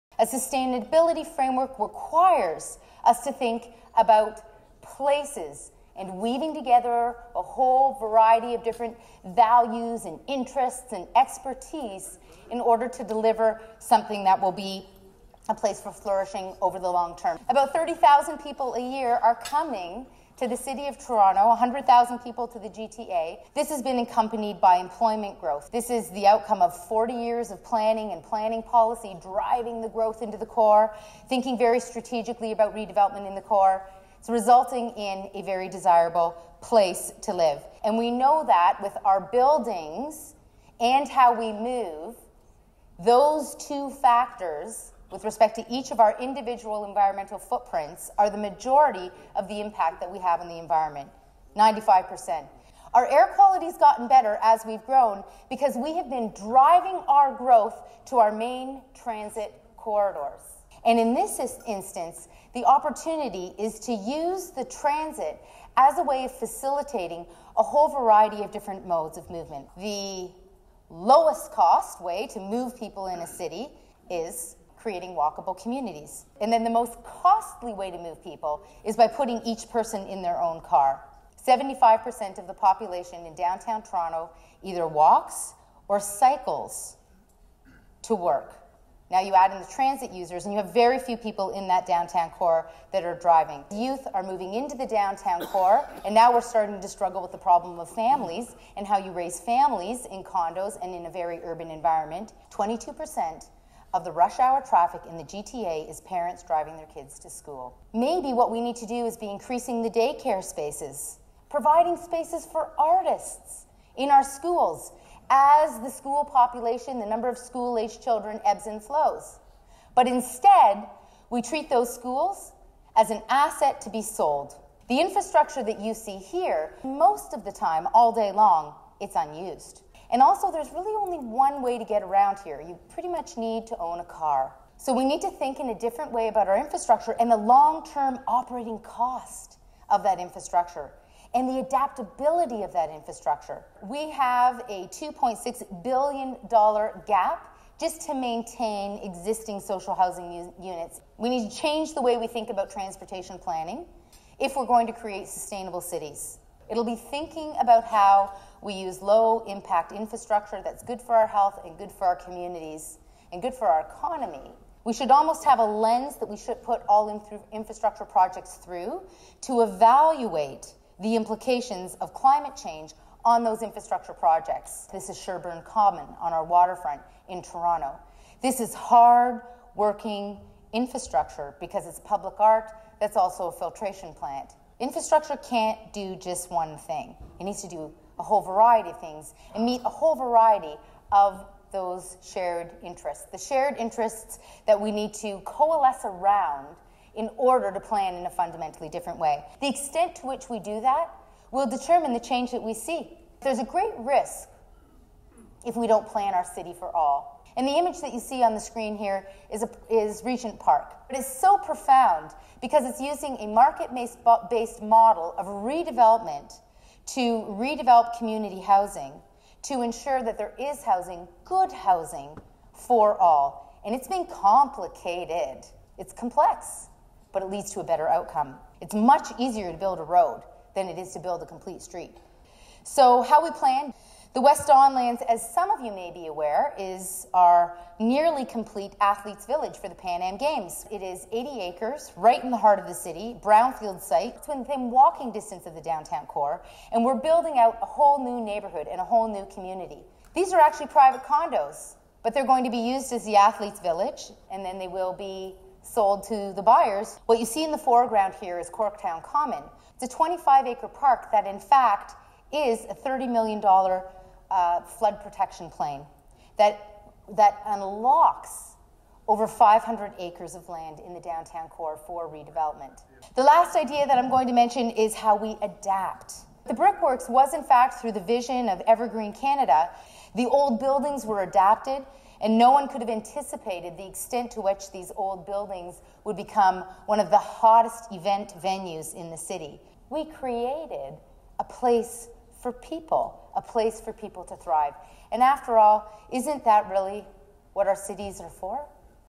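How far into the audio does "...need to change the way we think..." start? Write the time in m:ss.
2:31.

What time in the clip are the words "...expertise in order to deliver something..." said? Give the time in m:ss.
0:11.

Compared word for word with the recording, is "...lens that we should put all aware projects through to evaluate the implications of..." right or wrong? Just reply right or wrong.
wrong.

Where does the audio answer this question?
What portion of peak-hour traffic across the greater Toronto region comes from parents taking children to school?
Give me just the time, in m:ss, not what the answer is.
1:42.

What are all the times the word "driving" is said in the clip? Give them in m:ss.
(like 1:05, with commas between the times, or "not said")
0:29, 0:56, 1:33, 1:46.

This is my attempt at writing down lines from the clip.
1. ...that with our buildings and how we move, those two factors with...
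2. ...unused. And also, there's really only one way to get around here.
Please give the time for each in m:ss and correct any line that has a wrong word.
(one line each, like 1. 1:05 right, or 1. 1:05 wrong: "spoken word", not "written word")
1. 0:38 right
2. 2:09 right.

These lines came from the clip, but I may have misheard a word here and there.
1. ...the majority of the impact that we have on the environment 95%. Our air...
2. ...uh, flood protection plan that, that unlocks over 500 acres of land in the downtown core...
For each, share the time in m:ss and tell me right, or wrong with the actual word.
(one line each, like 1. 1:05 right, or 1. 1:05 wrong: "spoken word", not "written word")
1. 0:48 right
2. 4:24 right.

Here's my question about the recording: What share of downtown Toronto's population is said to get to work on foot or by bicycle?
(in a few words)
75%.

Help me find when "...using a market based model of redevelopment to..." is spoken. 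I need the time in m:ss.
3:33.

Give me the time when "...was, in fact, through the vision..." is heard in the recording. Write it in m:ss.
4:37.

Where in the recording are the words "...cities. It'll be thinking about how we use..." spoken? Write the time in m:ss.
2:35.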